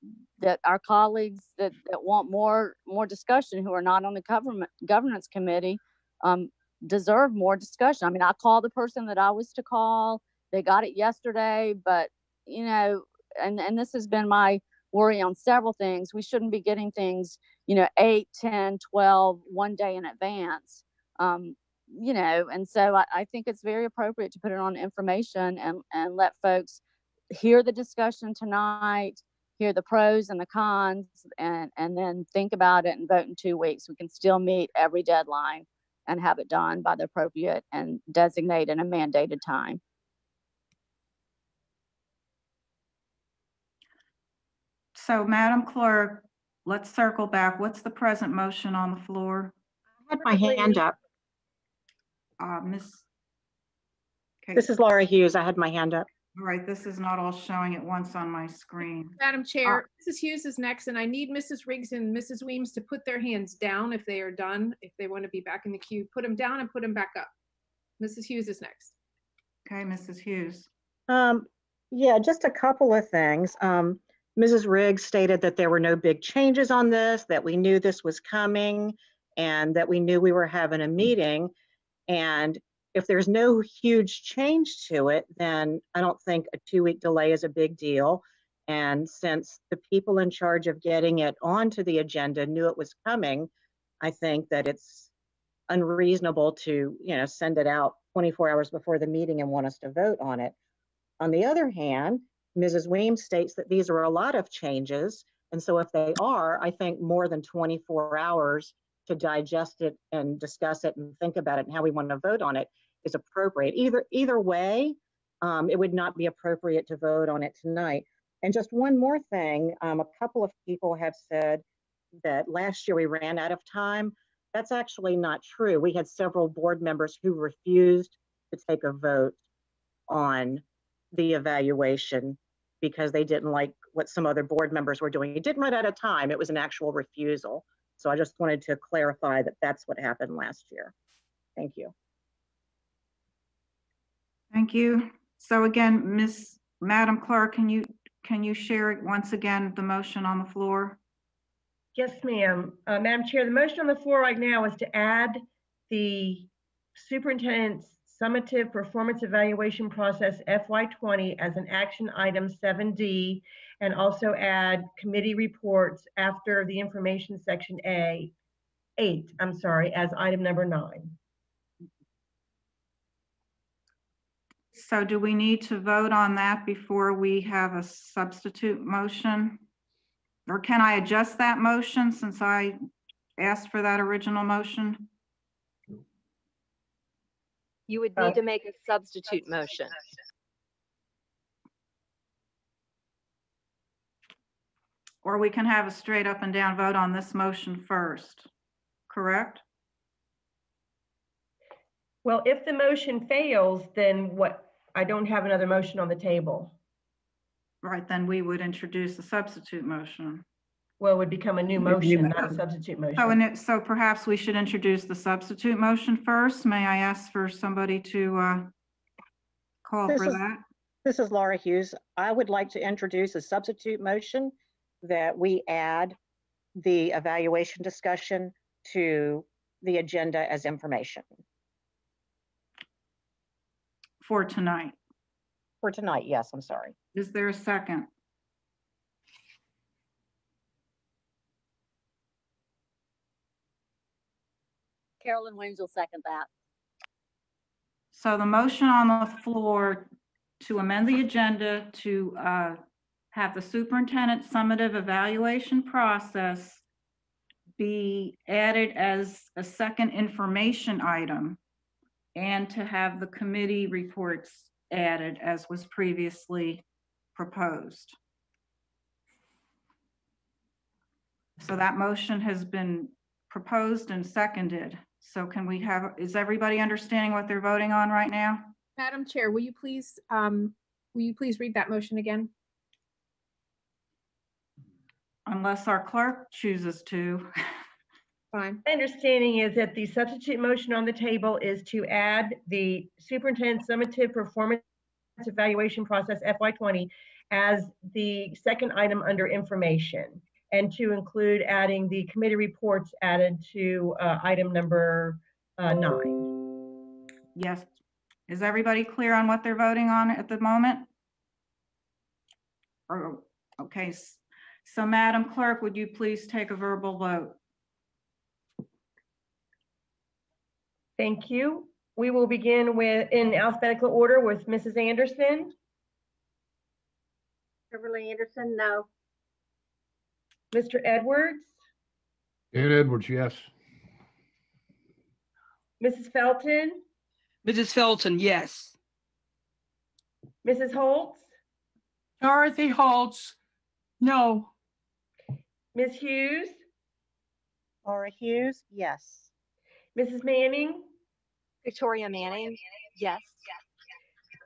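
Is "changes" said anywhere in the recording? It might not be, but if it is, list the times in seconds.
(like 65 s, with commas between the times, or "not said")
76 s, 84 s, 104 s.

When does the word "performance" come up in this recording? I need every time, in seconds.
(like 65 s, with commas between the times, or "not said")
158 s, 294 s.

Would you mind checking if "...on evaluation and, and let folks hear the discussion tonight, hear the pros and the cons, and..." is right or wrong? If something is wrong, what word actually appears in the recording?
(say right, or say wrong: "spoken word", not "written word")
wrong: "information", not "evaluation".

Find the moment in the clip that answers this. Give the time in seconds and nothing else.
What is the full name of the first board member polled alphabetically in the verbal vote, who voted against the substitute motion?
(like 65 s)
327 s.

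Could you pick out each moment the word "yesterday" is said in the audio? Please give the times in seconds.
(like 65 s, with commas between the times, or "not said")
10 s.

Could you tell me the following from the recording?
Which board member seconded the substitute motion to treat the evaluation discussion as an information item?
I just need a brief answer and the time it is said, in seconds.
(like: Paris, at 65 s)
Carolyn Williams, at 245 s.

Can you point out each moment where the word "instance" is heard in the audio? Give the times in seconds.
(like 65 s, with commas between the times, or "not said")
not said.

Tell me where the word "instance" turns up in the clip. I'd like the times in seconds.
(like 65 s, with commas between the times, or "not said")
not said.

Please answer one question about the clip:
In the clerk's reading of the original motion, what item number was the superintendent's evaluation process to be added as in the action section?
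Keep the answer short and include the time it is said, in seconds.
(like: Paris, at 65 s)
7D, at 162 s.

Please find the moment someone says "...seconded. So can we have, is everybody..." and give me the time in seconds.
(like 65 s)
274 s.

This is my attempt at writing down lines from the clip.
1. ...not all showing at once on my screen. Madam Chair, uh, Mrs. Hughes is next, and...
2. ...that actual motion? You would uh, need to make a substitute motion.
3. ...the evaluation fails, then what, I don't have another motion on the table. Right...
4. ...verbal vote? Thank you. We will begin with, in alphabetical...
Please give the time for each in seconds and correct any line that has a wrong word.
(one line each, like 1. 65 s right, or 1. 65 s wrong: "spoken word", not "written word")
1. 56 s right
2. 183 s wrong: "original", not "actual"
3. 202 s wrong: "motion", not "evaluation"
4. 316 s right.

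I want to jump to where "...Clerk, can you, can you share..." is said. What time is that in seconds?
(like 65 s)
147 s.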